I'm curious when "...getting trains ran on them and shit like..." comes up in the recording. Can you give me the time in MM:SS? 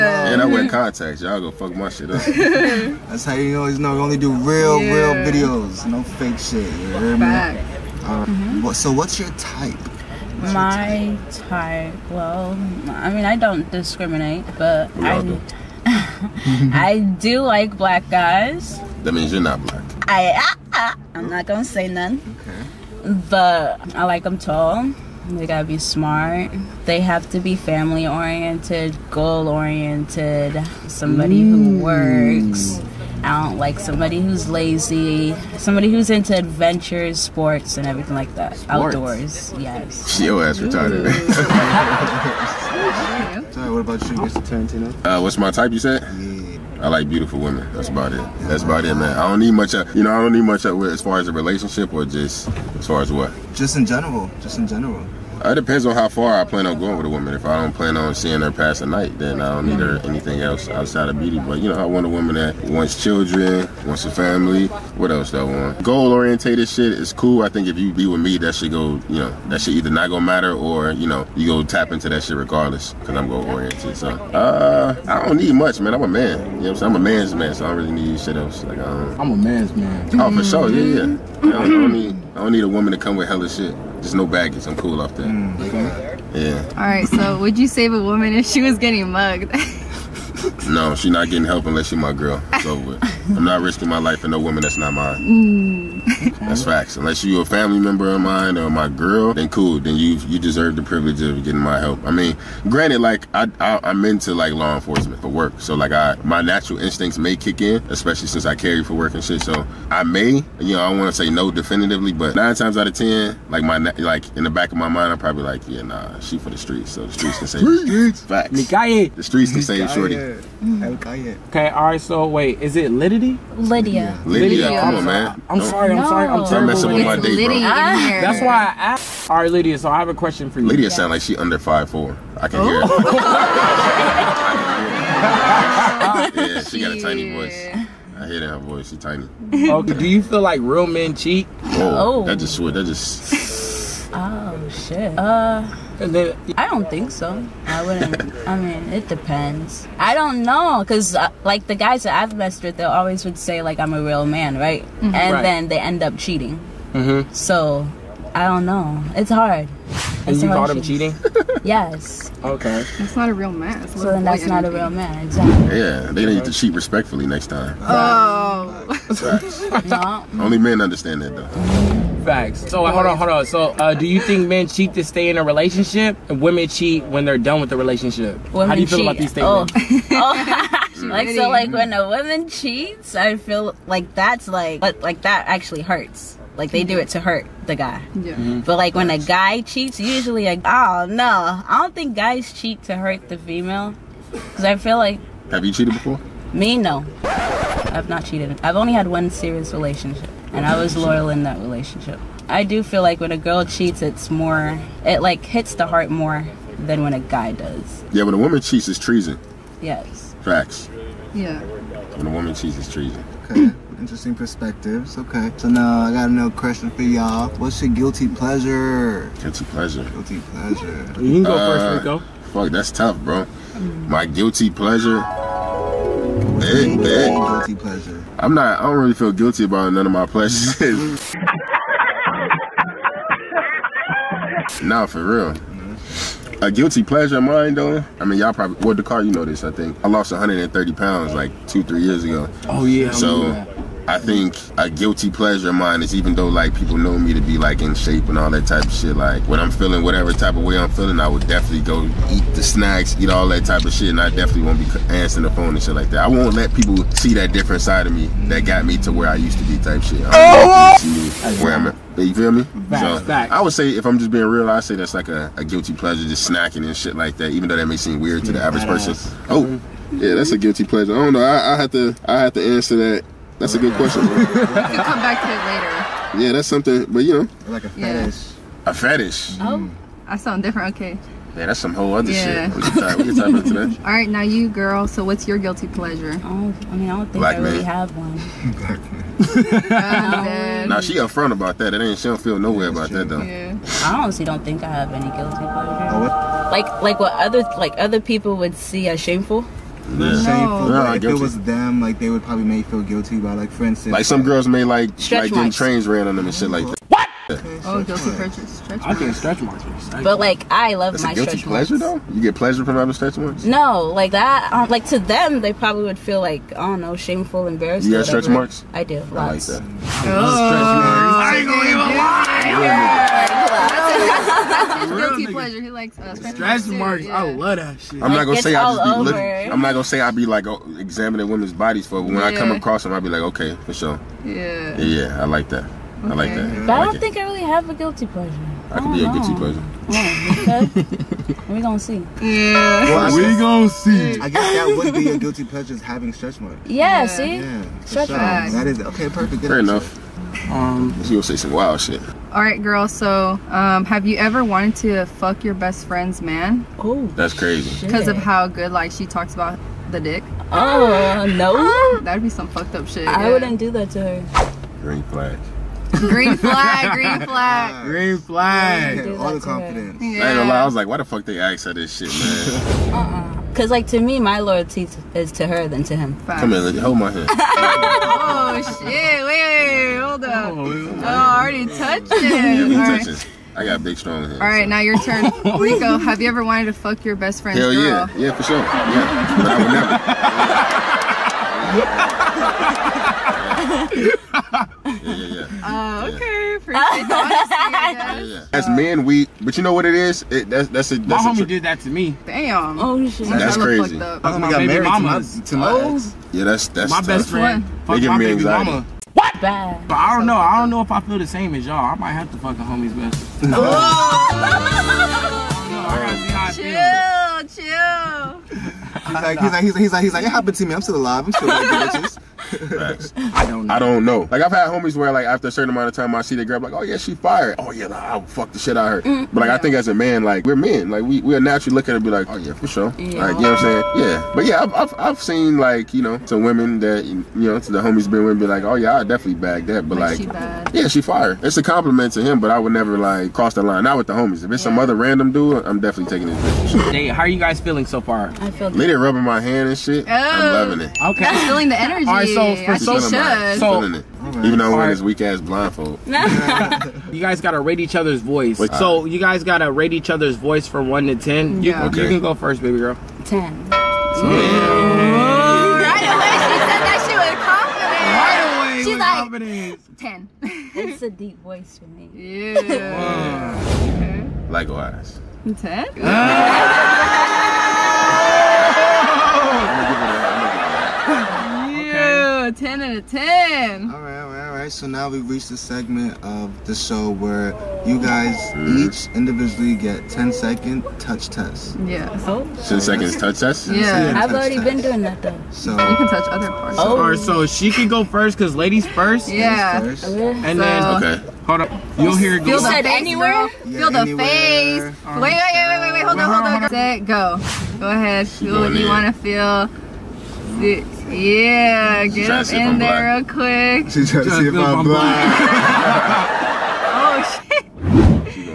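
05:05.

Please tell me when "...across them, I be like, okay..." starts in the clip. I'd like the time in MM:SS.
05:32.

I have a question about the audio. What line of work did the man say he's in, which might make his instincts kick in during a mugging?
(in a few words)
Law enforcement.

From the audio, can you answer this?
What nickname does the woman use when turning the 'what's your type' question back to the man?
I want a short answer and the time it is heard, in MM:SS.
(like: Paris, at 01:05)
Mr. Tarantino, at 00:44.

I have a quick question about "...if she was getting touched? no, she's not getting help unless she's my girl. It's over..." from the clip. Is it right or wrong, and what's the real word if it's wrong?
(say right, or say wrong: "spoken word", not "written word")
wrong: "mugged", not "touched".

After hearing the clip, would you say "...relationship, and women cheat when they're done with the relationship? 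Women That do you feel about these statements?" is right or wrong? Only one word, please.
wrong.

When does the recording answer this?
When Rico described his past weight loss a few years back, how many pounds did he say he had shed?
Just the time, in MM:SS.
04:00.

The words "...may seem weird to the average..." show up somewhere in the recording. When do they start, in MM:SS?
04:27.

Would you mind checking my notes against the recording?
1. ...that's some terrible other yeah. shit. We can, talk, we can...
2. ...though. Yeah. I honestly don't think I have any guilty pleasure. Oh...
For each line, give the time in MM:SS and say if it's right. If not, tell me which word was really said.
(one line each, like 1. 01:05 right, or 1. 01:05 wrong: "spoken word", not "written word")
1. 04:41 wrong: "whole", not "terrible"
2. 04:53 right.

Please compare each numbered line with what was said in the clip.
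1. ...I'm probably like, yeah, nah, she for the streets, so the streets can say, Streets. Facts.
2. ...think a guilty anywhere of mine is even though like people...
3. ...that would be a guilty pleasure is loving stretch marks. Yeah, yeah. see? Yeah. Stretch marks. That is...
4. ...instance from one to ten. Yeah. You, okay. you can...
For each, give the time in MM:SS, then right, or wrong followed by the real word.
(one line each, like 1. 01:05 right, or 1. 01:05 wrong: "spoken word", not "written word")
1. 01:55 right
2. 04:04 wrong: "pleasure", not "anywhere"
3. 05:44 wrong: "having", not "loving"
4. 07:40 wrong: "voice", not "instance".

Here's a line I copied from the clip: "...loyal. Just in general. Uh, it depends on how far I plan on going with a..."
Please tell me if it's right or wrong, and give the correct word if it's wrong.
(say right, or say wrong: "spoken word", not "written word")
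wrong: "general", not "loyal".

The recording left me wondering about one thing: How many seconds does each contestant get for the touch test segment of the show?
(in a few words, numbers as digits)
10.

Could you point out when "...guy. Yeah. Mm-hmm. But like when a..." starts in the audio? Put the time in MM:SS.
03:07.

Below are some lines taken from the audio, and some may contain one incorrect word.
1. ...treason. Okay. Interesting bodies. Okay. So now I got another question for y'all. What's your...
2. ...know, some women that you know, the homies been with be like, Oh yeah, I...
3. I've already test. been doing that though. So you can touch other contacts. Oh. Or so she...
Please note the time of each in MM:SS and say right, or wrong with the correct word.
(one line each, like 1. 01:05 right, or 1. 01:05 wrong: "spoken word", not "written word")
1. 03:32 wrong: "perspectives", not "bodies"
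2. 07:16 right
3. 08:14 wrong: "parts", not "contacts".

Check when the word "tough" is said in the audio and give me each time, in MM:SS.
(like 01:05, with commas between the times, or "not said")
03:42, 06:47.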